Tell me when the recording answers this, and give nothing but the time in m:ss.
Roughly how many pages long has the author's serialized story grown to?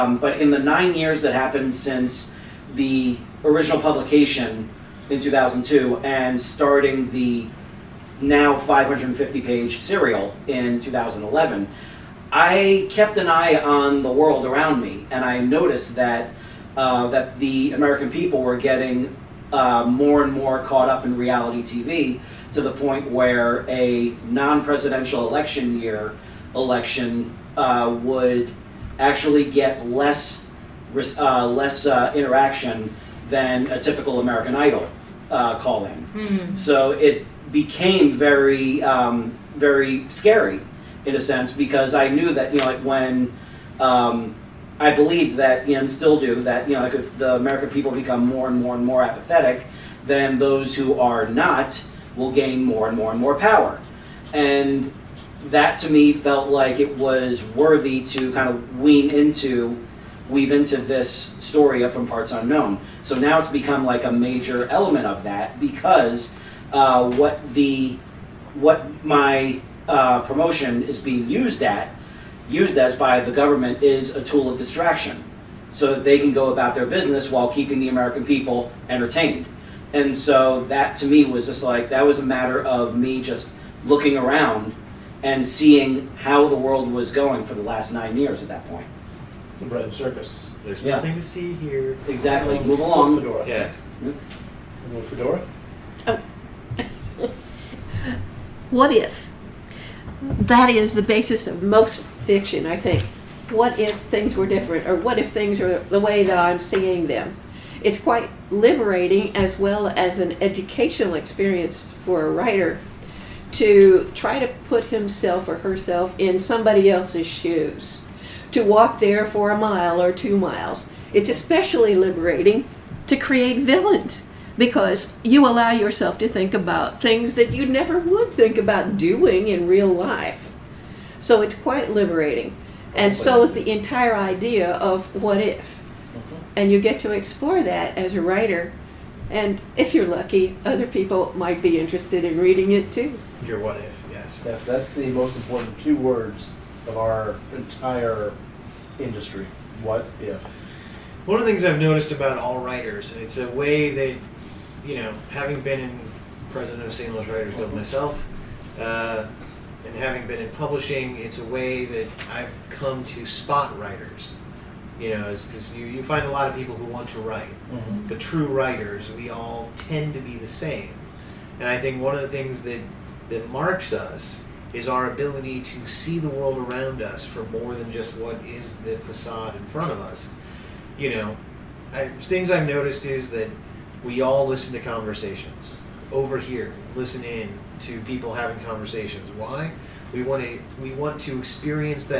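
0:08.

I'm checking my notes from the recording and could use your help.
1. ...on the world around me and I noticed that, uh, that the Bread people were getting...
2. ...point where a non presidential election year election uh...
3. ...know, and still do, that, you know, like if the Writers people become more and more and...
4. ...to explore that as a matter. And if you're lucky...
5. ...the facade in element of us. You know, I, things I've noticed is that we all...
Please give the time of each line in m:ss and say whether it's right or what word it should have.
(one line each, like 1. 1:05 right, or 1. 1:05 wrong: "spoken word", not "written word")
1. 0:13 wrong: "American", not "Bread"
2. 0:22 right
3. 0:45 wrong: "American", not "Writers"
4. 2:17 wrong: "writer", not "matter"
5. 2:58 wrong: "front", not "element".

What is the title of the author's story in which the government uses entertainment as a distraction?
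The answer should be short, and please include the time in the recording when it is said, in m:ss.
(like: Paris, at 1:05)
From Parts Unknown, at 1:01.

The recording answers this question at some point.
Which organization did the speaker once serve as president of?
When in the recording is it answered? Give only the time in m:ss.
2:36.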